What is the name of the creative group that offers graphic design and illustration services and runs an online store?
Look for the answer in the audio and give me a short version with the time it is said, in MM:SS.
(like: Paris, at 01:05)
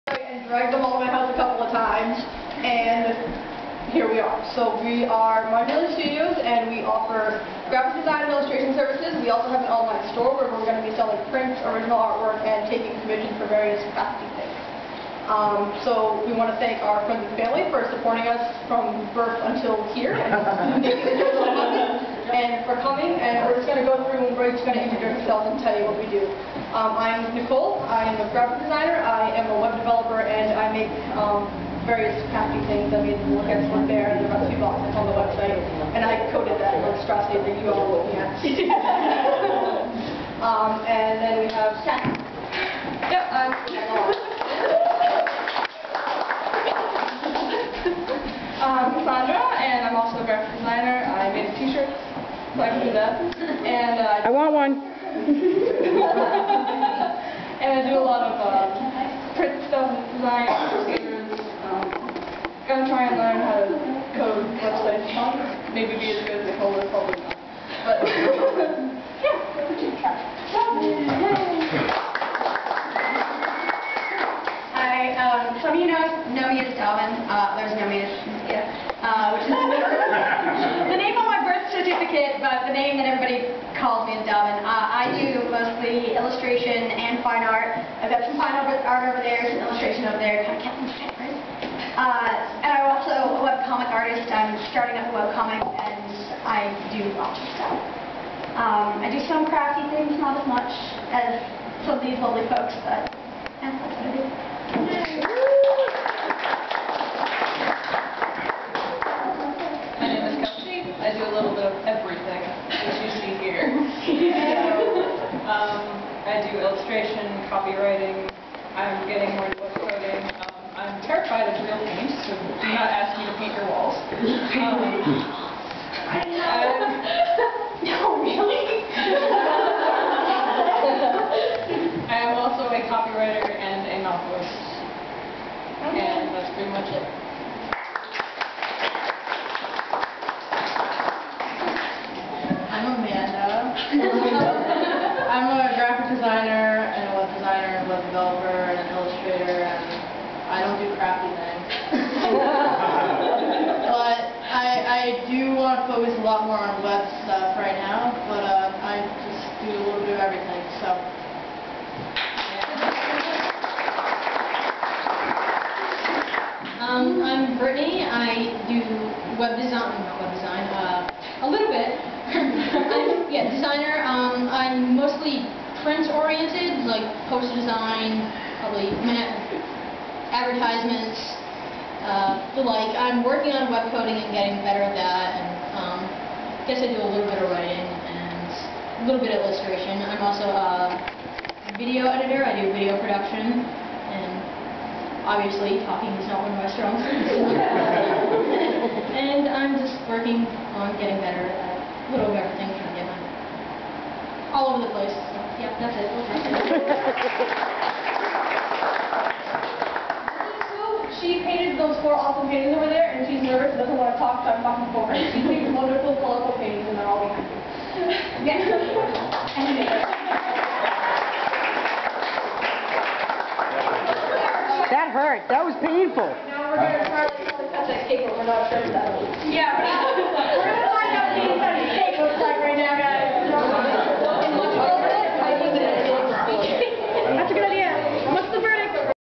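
Modular Studios, at 00:05.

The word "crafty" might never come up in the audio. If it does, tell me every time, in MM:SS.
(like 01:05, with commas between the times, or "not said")
00:13, 00:32, 01:39.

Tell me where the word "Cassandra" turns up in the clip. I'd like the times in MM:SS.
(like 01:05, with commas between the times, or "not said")
00:48.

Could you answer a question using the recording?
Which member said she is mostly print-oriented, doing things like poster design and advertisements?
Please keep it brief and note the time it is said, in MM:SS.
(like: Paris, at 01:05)
Brittany, at 02:47.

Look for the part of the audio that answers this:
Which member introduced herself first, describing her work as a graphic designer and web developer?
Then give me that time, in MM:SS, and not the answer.
00:27.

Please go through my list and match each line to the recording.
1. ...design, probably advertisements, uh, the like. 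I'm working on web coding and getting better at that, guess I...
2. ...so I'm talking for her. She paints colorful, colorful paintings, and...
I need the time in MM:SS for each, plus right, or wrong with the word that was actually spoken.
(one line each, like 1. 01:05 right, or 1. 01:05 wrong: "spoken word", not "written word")
1. 02:57 right
2. 03:34 wrong: "wonderful", not "colorful".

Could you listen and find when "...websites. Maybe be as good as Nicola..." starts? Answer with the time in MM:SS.
01:04.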